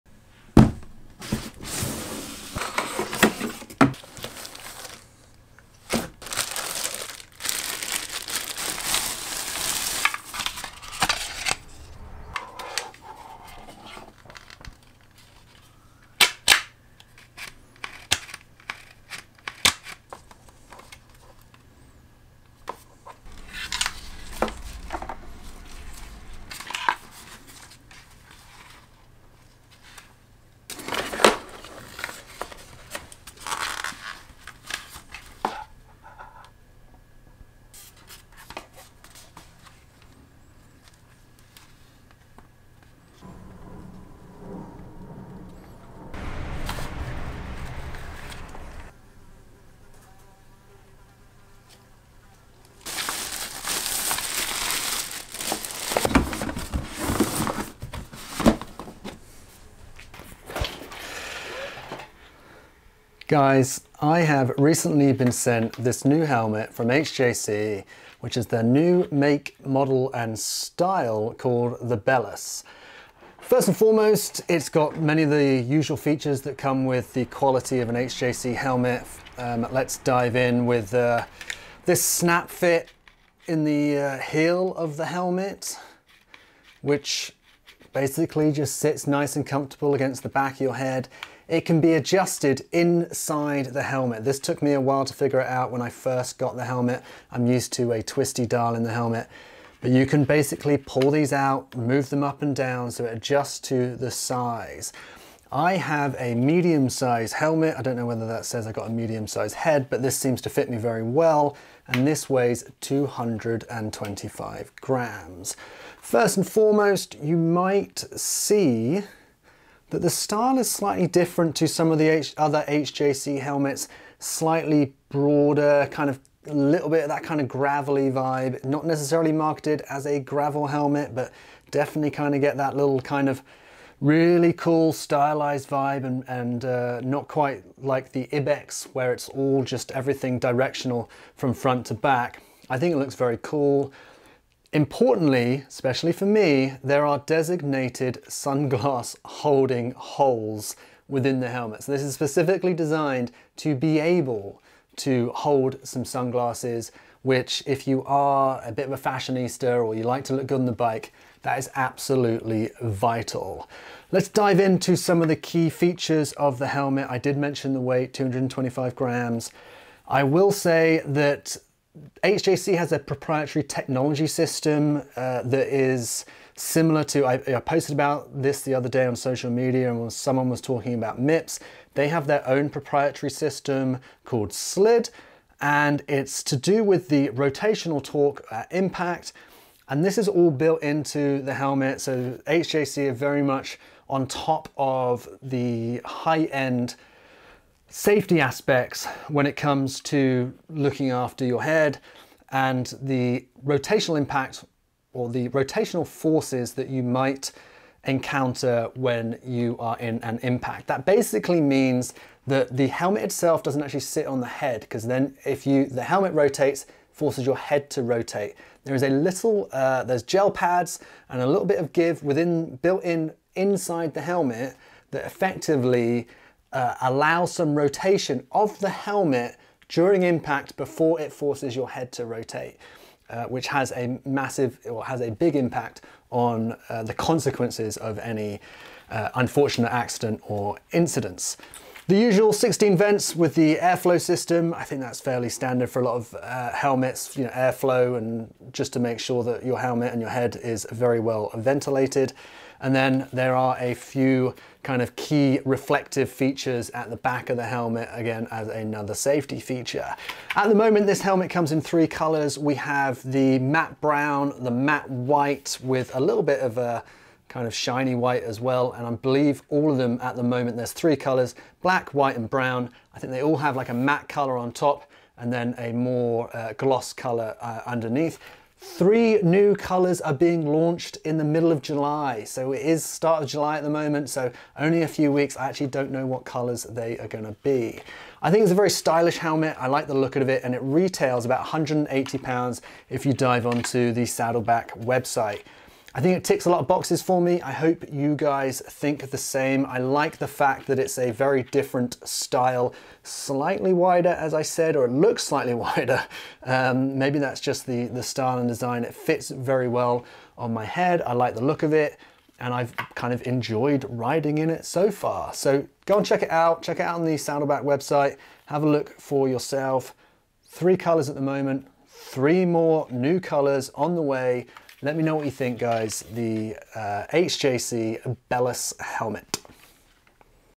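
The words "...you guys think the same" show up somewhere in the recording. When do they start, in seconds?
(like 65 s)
298 s.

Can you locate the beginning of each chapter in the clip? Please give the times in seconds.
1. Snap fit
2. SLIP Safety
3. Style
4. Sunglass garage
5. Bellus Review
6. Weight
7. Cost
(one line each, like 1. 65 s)
1. 80 s
2. 175 s
3. 120 s
4. 143 s
5. 60 s
6. 110 s
7. 290 s.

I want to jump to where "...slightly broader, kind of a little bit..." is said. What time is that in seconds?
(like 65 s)
124 s.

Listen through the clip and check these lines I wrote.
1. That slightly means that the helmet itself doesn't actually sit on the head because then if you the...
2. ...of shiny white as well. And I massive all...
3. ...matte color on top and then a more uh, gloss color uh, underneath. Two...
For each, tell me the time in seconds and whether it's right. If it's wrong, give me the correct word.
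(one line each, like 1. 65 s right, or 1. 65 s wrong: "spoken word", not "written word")
1. 210 s wrong: "basically", not "slightly"
2. 267 s wrong: "believe", not "massive"
3. 273 s wrong: "Three", not "Two".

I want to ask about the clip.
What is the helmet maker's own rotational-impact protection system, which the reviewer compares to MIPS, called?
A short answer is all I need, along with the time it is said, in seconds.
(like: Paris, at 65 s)
SLIP, at 184 s.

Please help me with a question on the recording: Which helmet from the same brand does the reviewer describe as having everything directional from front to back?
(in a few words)
Ibex.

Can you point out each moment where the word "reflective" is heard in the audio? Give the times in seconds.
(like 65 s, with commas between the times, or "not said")
255 s.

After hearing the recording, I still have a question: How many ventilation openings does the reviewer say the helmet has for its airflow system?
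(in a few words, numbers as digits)
16.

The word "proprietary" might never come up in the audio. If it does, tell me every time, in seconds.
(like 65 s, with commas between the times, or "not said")
172 s, 182 s.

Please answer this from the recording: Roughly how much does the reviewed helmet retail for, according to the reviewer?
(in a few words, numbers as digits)
180 pounds.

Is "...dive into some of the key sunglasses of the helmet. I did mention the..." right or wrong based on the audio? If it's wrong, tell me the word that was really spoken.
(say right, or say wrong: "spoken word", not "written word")
wrong: "features", not "sunglasses".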